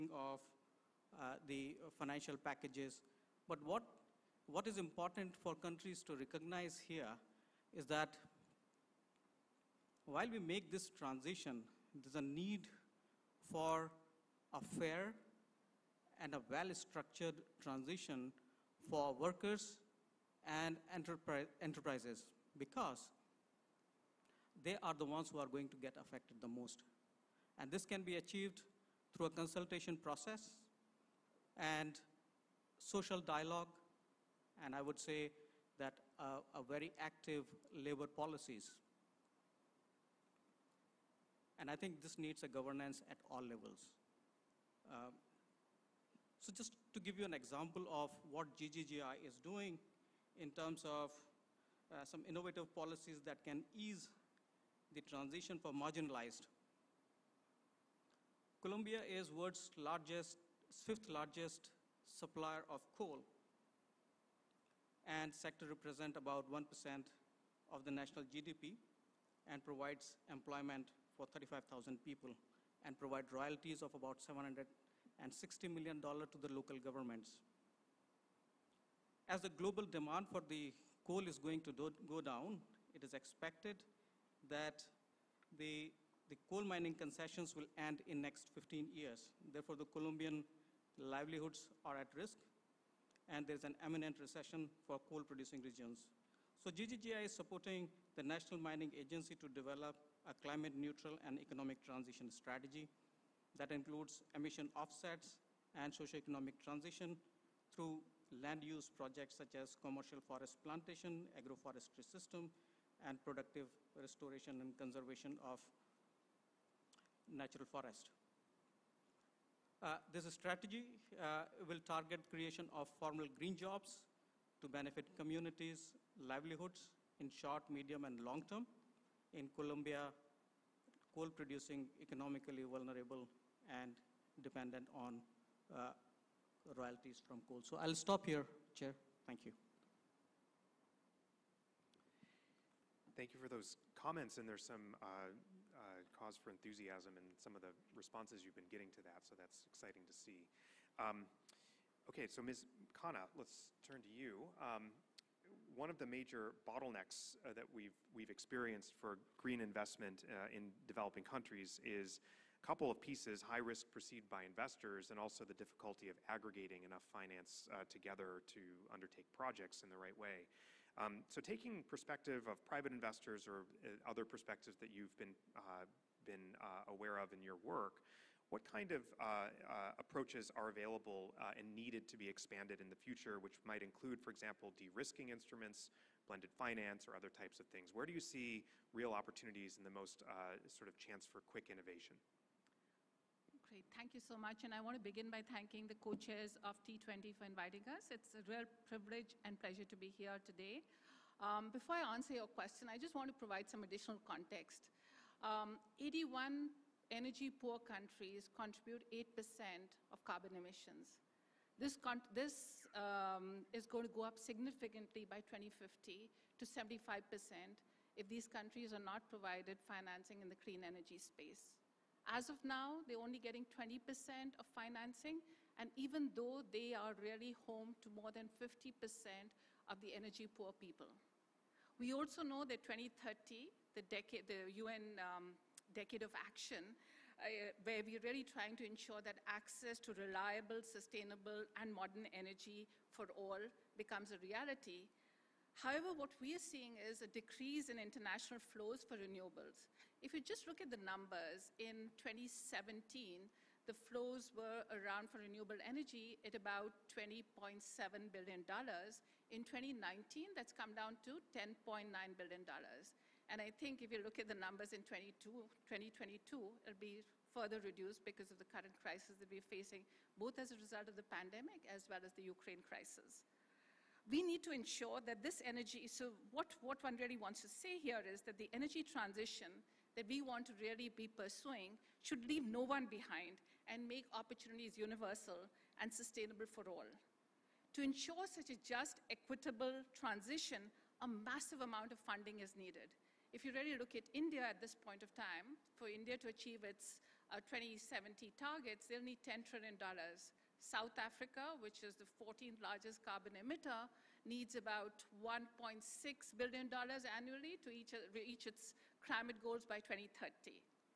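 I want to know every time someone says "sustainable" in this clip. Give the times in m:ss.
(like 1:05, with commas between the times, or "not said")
4:00, 4:46.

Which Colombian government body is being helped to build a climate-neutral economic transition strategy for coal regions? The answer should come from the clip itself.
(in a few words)
National Mining Agency.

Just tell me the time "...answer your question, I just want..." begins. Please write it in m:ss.
3:22.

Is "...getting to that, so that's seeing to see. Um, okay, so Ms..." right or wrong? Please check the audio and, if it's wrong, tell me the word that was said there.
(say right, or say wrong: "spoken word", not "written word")
wrong: "exciting", not "seeing".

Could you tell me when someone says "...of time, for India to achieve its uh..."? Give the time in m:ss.
4:55.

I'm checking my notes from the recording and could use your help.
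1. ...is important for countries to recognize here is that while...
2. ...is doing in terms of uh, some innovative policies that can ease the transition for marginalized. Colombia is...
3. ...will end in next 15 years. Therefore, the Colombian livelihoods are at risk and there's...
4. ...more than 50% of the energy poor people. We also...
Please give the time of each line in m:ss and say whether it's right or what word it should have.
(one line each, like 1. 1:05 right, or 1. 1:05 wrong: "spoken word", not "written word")
1. 0:04 right
2. 0:49 right
3. 1:27 right
4. 3:48 right.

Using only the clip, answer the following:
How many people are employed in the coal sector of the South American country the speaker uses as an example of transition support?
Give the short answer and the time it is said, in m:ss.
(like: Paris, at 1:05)
35,000, at 1:11.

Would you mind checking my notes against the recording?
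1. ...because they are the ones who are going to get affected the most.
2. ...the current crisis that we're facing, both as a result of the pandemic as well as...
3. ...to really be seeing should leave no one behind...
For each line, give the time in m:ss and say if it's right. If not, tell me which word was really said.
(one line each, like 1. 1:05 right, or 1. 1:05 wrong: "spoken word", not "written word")
1. 0:22 right
2. 4:28 right
3. 4:40 wrong: "pursuing", not "seeing".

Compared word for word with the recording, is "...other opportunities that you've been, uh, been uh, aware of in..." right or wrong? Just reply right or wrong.
wrong.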